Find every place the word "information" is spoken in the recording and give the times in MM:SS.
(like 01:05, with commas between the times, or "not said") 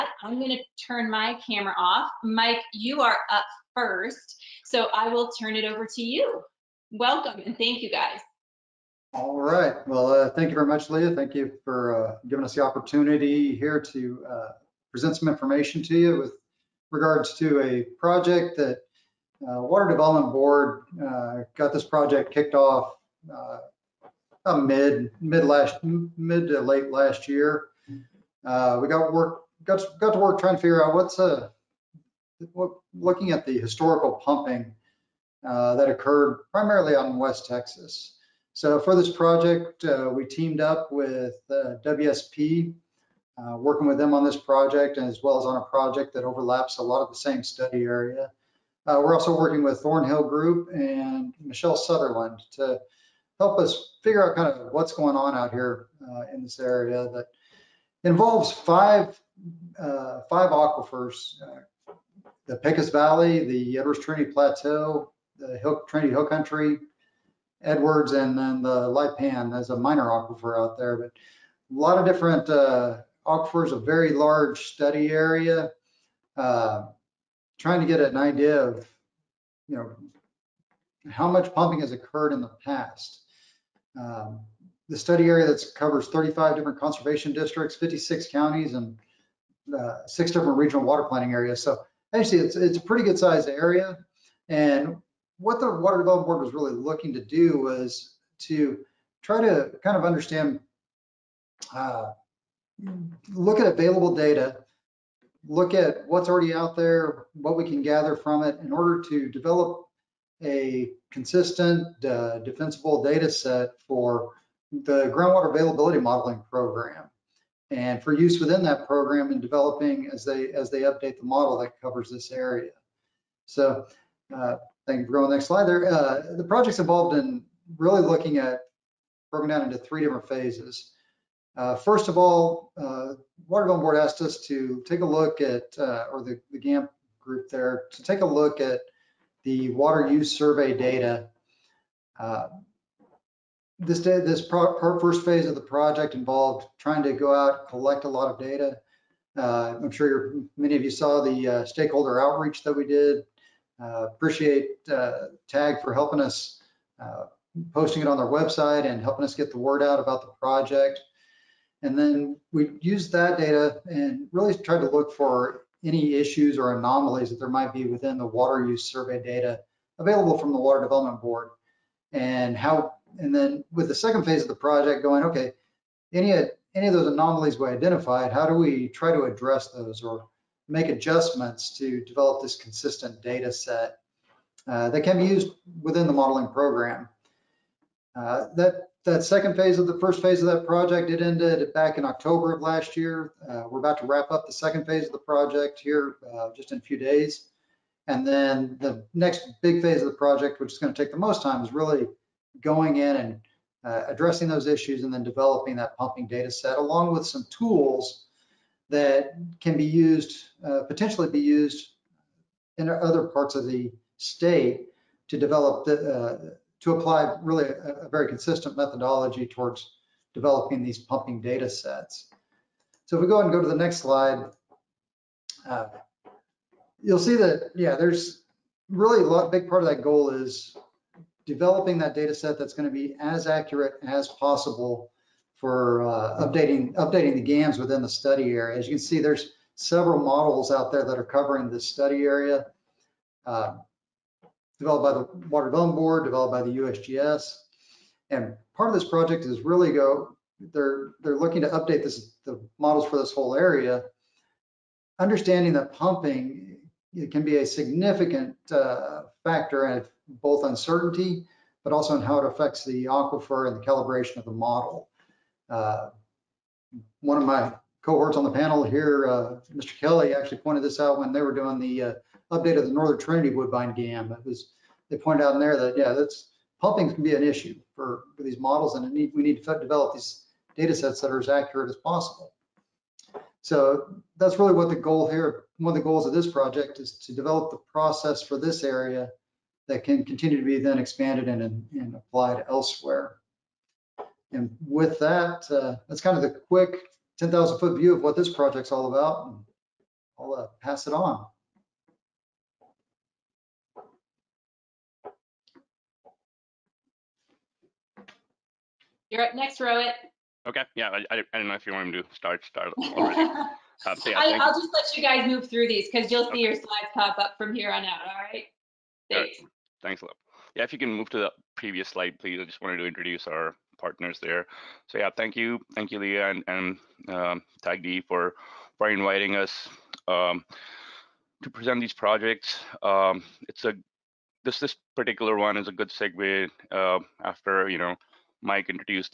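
00:15.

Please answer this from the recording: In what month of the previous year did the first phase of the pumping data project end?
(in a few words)
October.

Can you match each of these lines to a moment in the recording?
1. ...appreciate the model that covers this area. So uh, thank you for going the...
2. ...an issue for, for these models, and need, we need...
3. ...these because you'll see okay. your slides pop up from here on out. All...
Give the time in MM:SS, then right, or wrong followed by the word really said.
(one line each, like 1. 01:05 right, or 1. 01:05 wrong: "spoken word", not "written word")
1. 02:00 wrong: "update", not "appreciate"
2. 04:37 right
3. 05:15 right.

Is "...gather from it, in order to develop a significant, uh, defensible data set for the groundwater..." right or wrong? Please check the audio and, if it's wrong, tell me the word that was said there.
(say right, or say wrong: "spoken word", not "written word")
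wrong: "consistent", not "significant".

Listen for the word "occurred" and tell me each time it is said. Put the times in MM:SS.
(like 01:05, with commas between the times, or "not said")
00:35, 01:21.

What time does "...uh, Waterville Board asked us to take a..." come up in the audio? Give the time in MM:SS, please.
02:12.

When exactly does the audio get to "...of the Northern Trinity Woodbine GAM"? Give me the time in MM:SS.
04:32.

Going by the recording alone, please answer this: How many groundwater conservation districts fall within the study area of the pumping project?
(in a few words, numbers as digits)
35.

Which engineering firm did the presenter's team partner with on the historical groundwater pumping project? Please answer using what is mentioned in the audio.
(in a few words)
WSP.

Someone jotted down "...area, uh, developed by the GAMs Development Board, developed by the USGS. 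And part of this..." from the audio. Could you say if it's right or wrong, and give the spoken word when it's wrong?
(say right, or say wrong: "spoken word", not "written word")
wrong: "Water", not "GAMs".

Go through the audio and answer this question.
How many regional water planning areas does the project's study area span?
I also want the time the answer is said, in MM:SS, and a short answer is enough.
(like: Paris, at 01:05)
6, at 01:30.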